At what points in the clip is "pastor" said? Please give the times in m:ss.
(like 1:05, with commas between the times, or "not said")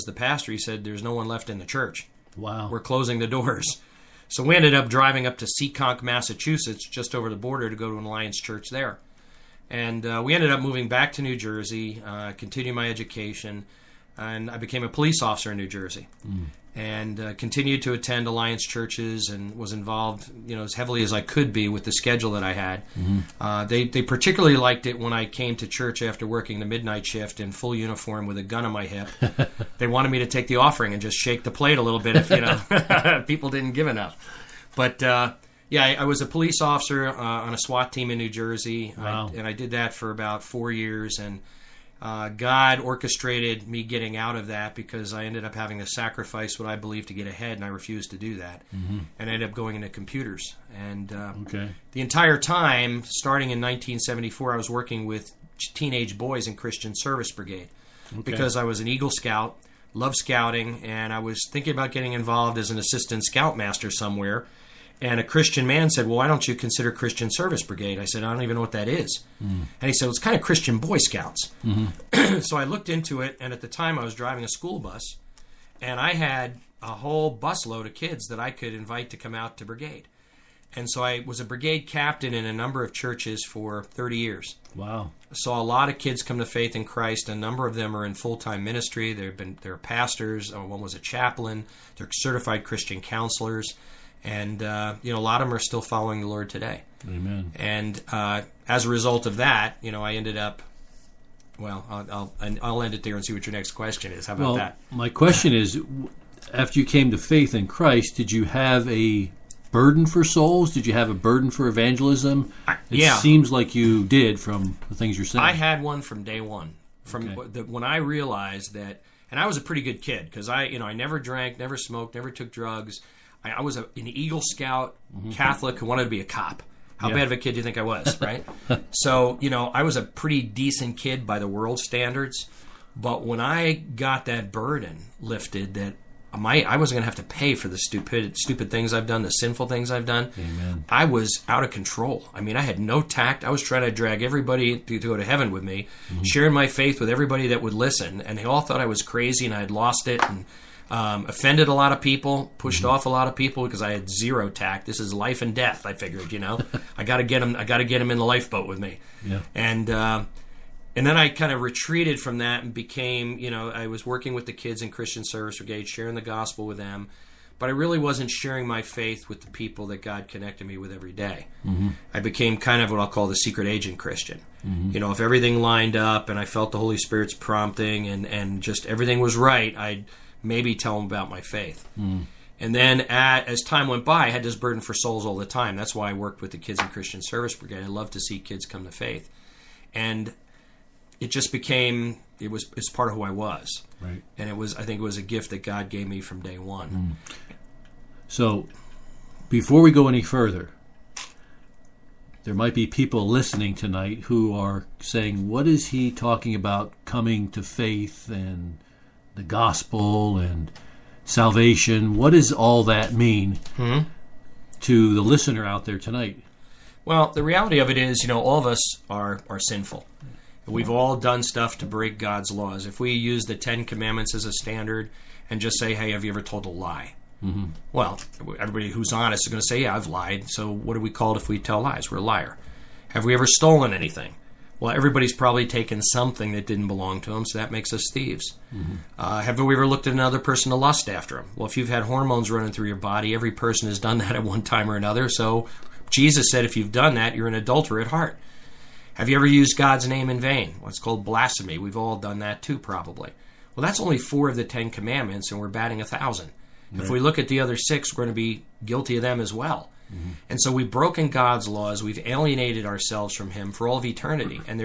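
0:00, 1:29.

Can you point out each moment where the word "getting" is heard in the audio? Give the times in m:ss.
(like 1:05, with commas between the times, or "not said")
0:43, 1:01.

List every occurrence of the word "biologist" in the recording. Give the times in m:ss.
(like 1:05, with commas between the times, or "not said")
not said.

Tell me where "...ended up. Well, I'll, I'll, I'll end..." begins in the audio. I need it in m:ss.
1:40.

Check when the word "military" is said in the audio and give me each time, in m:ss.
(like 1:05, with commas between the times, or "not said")
not said.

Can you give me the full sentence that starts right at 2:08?
so, you know, I was a pretty decent kid by the world standards.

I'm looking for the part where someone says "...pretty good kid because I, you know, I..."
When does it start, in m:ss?
1:59.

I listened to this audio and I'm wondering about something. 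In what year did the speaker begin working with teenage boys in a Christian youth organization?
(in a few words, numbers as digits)
1974.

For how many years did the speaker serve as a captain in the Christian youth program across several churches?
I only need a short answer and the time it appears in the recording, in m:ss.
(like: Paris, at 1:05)
30 years, at 1:23.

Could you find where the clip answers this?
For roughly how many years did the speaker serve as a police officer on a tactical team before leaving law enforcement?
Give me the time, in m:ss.
0:40.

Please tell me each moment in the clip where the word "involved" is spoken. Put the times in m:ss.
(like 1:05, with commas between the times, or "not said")
0:19, 1:02.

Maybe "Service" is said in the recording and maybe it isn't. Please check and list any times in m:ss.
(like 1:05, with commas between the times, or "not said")
0:56, 1:07, 2:45, 3:07.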